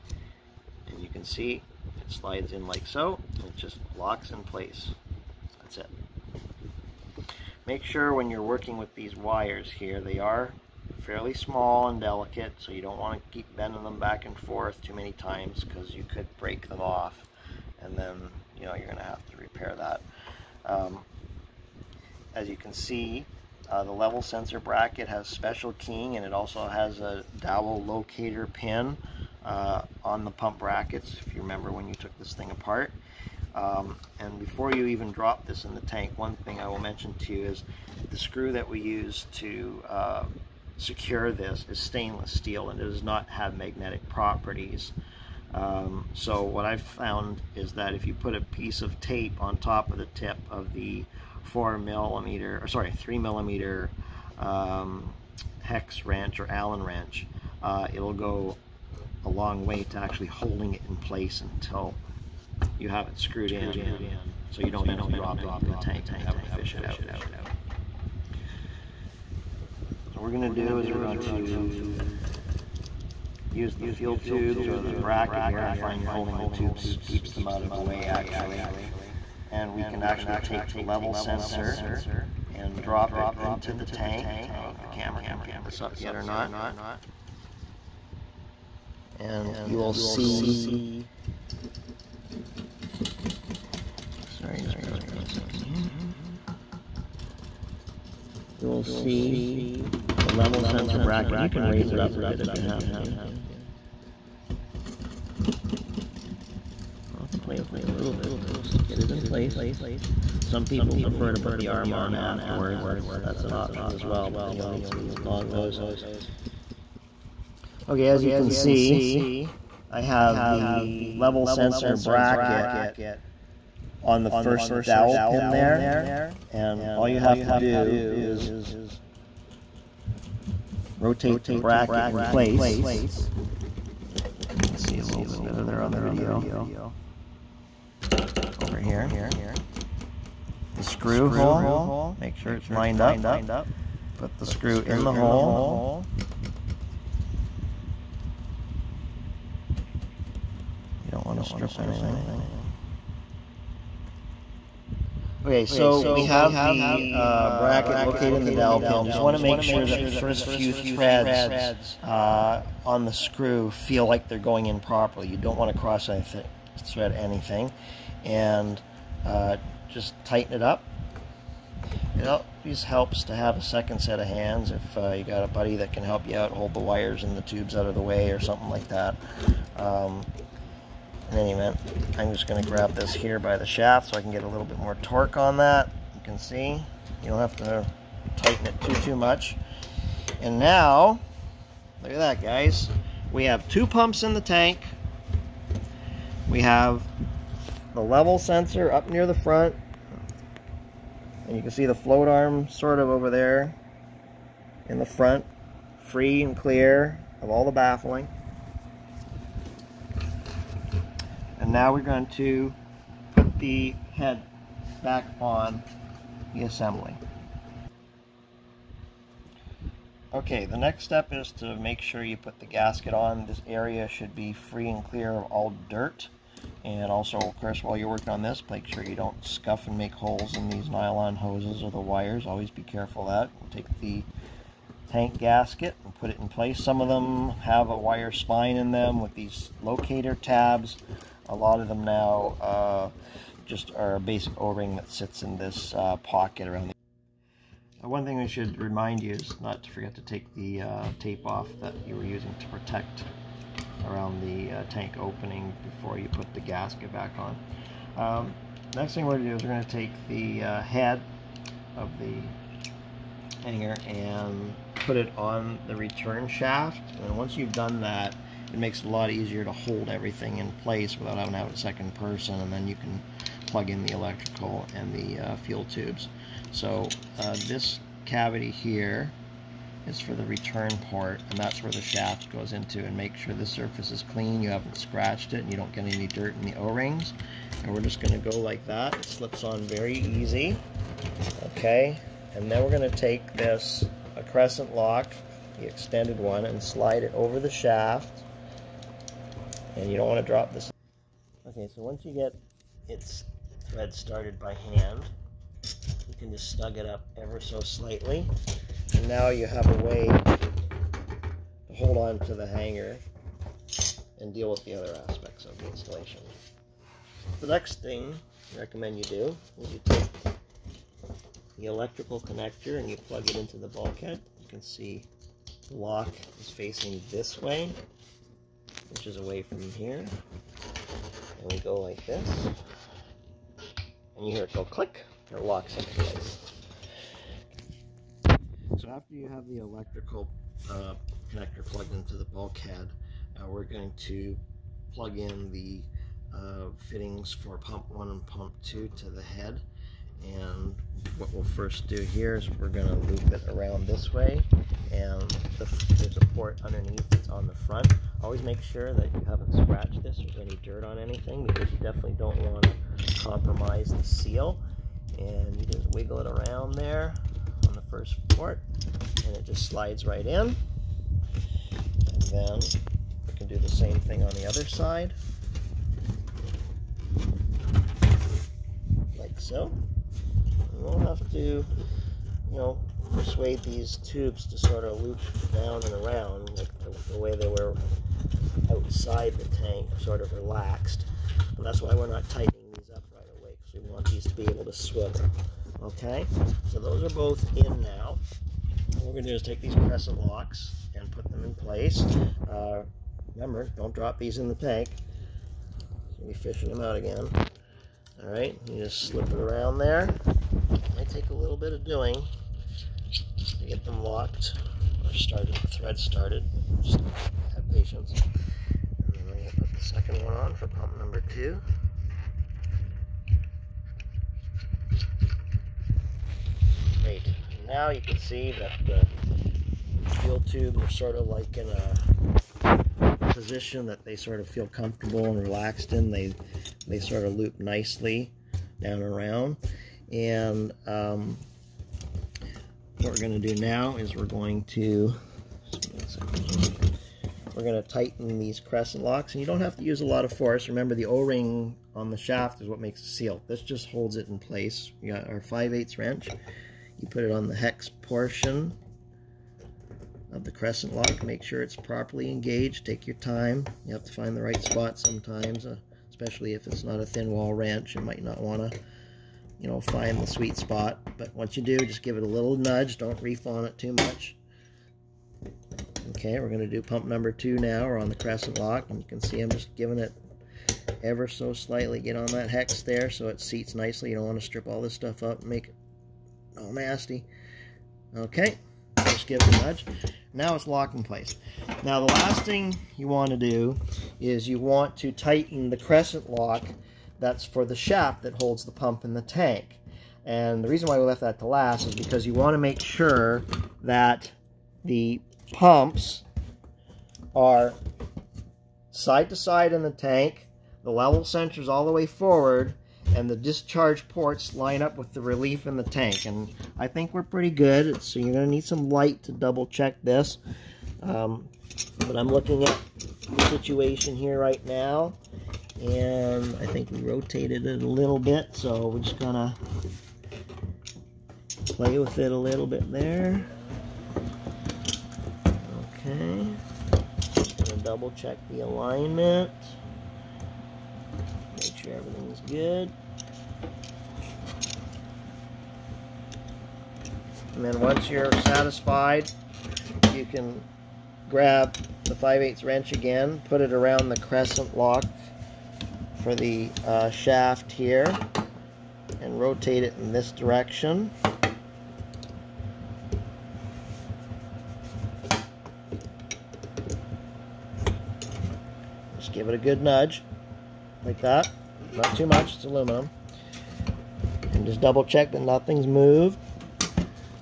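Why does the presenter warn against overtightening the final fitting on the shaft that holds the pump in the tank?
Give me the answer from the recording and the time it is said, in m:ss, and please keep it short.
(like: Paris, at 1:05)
It's aluminum, at 9:32.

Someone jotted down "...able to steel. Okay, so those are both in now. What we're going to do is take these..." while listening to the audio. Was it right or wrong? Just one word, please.
wrong.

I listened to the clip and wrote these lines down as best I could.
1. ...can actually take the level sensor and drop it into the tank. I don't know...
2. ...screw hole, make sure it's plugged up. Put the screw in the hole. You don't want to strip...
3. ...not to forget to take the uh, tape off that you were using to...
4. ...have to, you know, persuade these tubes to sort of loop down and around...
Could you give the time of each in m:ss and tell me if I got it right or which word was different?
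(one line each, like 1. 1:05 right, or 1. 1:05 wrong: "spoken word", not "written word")
1. 1:19 right
2. 2:20 wrong: "lined", not "plugged"
3. 4:09 right
4. 6:21 right.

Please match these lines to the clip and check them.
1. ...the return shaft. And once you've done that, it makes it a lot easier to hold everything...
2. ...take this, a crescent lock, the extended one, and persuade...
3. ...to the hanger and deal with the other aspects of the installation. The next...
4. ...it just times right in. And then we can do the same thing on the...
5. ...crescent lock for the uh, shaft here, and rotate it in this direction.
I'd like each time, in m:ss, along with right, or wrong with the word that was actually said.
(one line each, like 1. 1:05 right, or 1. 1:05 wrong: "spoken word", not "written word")
1. 4:25 right
2. 4:53 wrong: "slide", not "persuade"
3. 5:12 right
4. 6:09 wrong: "slides", not "times"
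5. 9:14 right.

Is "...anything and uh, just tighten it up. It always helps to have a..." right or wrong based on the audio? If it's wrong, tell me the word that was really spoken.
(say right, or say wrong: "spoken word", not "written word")
right.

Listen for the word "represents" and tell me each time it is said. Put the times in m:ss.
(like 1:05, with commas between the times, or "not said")
not said.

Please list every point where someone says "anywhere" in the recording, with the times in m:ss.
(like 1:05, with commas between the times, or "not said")
not said.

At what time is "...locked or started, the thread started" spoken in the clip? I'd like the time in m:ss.
6:54.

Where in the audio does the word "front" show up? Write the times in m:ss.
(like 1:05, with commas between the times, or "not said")
3:19, 3:25, 5:57.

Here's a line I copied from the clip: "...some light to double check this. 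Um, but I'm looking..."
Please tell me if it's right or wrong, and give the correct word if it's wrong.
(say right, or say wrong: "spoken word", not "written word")
right.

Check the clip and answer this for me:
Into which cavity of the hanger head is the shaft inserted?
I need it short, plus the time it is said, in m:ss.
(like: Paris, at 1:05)
Return part, at 4:40.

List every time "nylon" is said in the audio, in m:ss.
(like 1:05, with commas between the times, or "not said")
3:50.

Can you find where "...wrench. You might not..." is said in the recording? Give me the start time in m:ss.
7:47.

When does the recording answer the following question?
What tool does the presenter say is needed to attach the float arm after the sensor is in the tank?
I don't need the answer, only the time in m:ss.
1:55.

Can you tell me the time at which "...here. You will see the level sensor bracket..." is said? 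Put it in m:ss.
1:35.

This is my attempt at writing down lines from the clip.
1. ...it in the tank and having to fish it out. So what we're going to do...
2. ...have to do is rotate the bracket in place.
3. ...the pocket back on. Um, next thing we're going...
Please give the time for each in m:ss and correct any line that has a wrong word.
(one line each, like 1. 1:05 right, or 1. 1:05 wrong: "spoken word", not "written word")
1. 1:05 right
2. 2:07 right
3. 4:16 wrong: "gasket", not "pocket".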